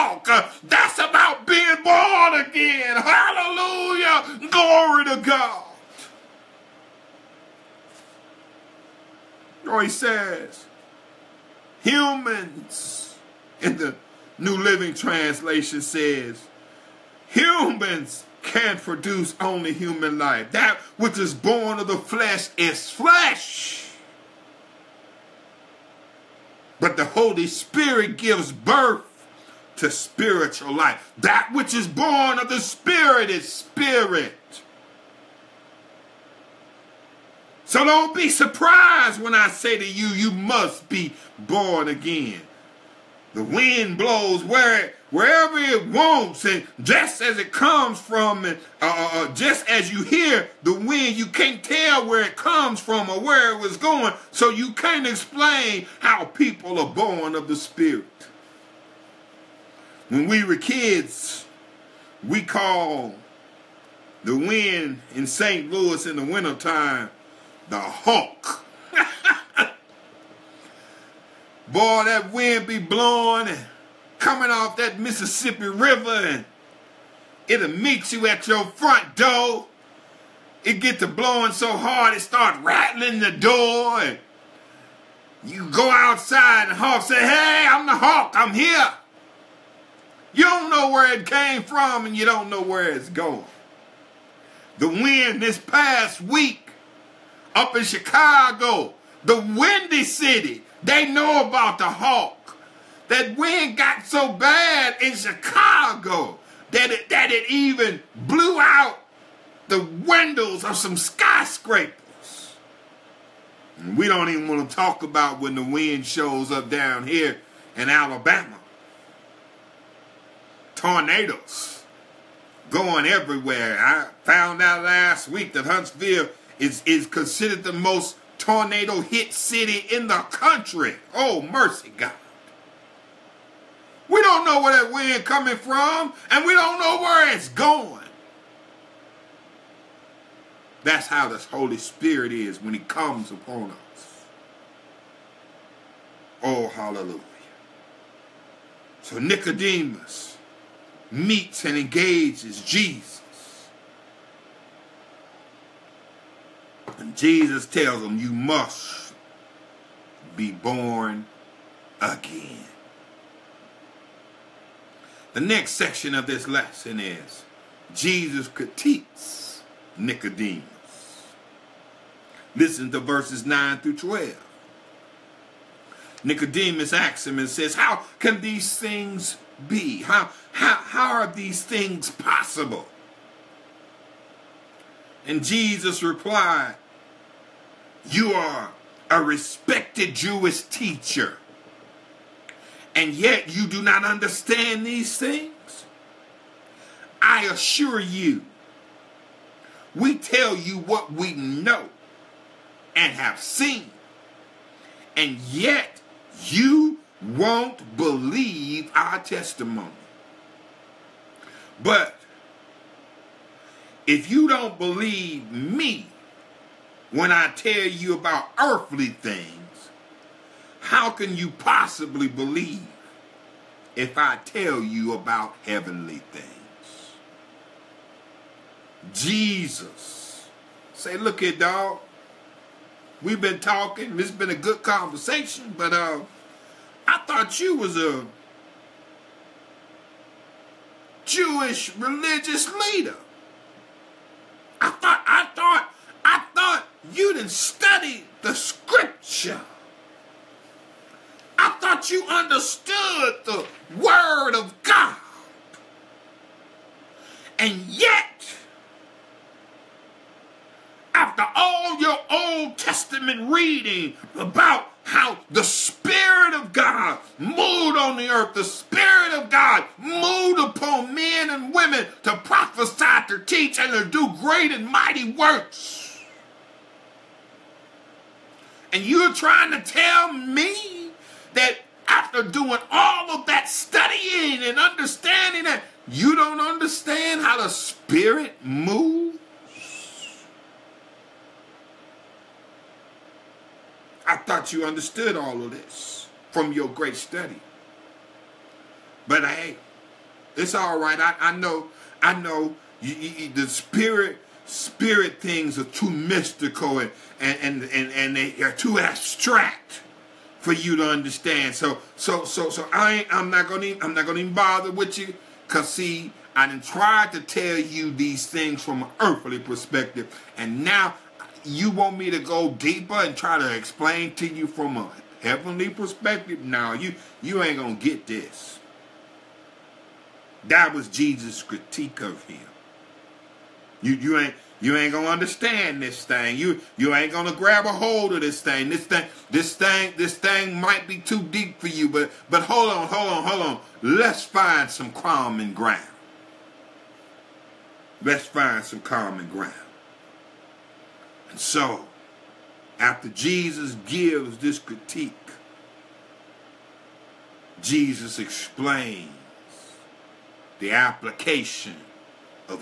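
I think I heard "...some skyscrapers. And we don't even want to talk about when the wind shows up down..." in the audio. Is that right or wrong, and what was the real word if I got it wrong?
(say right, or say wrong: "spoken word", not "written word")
right.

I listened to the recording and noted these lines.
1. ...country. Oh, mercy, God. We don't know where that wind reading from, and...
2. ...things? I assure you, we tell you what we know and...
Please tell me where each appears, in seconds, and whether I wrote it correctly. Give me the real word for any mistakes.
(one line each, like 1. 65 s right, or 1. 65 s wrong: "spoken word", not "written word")
1. 130 s wrong: "coming", not "reading"
2. 195 s right.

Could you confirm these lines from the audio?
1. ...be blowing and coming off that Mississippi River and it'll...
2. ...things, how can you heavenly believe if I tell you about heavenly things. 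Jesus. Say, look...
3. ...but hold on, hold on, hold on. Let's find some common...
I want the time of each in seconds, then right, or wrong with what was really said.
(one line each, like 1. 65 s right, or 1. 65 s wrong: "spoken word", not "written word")
1. 72 s right
2. 219 s wrong: "possibly", not "heavenly"
3. 342 s right.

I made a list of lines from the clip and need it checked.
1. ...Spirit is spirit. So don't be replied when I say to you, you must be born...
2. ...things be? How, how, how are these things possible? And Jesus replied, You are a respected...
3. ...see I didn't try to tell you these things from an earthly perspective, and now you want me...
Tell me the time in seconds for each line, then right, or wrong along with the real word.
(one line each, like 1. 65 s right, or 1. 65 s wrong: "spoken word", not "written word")
1. 32 s wrong: "surprised", not "replied"
2. 178 s right
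3. 315 s right.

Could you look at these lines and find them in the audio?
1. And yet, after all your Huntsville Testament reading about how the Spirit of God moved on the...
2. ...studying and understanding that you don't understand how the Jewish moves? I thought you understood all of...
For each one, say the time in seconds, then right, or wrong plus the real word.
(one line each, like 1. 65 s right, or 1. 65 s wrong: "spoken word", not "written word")
1. 257 s wrong: "Old", not "Huntsville"
2. 283 s wrong: "Spirit", not "Jewish".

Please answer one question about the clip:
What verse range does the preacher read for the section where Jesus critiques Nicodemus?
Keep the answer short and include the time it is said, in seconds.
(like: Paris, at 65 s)
9 through 12, at 172 s.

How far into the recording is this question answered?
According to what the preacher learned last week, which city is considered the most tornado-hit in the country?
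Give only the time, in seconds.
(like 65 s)
125 s.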